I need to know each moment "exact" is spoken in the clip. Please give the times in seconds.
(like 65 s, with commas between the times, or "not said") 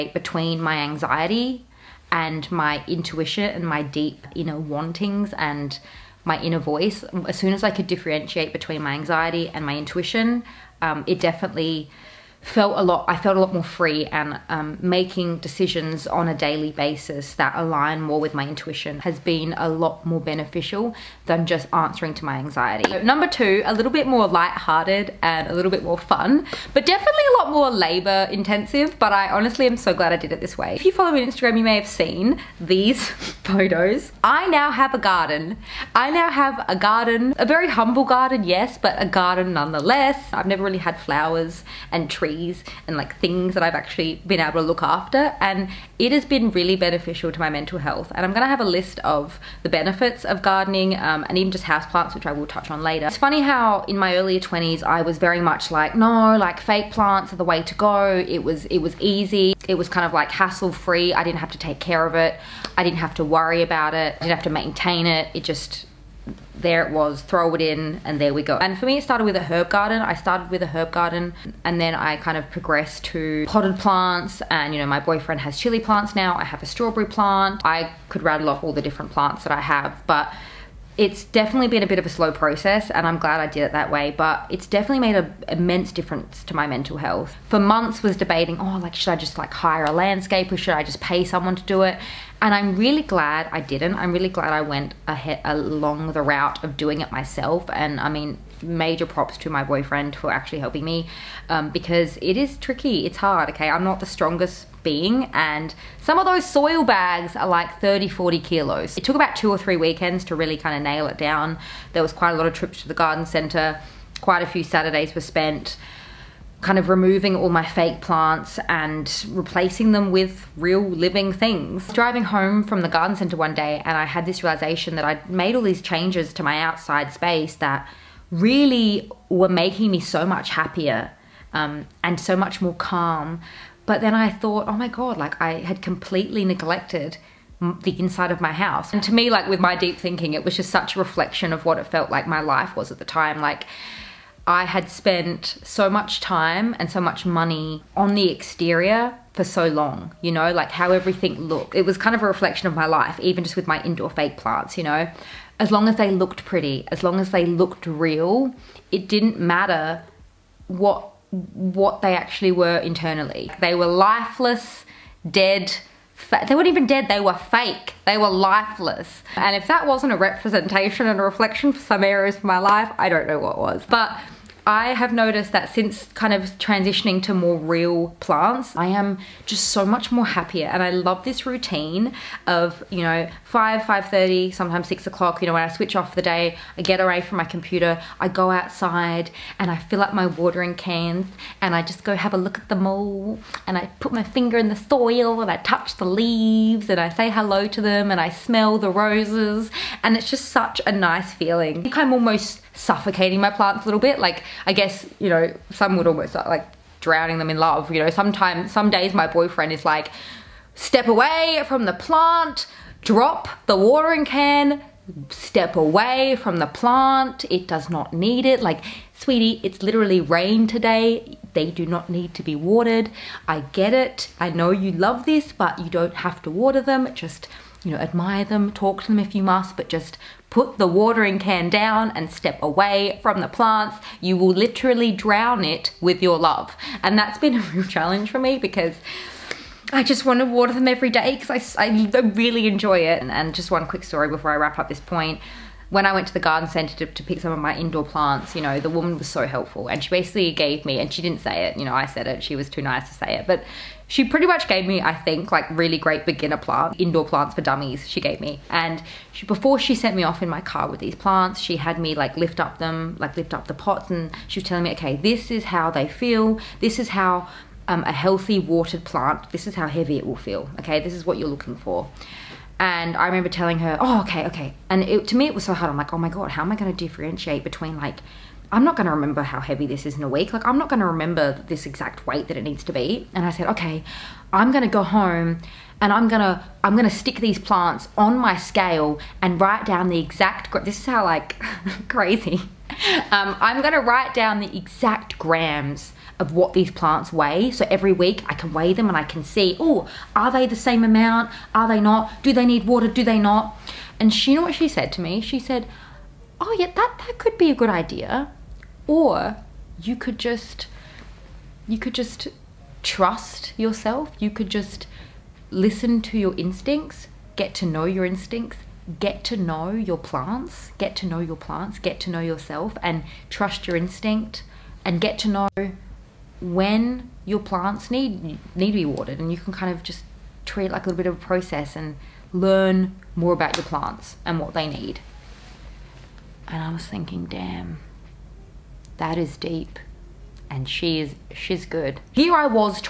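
281 s, 290 s, 294 s.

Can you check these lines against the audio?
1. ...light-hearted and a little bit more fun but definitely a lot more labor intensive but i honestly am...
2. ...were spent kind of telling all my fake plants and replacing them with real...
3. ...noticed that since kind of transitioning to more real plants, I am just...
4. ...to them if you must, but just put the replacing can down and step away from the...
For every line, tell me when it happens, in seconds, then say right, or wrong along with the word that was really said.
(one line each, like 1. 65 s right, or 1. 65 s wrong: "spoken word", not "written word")
1. 24 s right
2. 115 s wrong: "removing", not "telling"
3. 175 s right
4. 229 s wrong: "watering", not "replacing".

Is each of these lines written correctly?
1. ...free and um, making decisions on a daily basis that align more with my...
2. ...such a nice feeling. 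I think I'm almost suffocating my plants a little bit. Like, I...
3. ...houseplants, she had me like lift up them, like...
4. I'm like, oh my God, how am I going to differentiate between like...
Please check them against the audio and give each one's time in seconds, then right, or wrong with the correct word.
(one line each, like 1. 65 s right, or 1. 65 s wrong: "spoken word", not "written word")
1. 13 s right
2. 200 s right
3. 261 s wrong: "plants", not "houseplants"
4. 275 s right.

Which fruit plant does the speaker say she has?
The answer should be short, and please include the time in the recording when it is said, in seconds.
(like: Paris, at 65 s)
Strawberry, at 76 s.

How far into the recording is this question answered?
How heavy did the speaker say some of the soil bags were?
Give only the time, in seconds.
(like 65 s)
107 s.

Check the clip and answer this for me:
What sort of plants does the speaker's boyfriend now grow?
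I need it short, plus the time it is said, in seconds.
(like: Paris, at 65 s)
Chili plants, at 75 s.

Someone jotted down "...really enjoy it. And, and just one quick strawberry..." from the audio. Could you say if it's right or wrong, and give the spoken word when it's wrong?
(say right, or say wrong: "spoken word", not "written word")
wrong: "story", not "strawberry".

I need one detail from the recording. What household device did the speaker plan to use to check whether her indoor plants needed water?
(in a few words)
Scale.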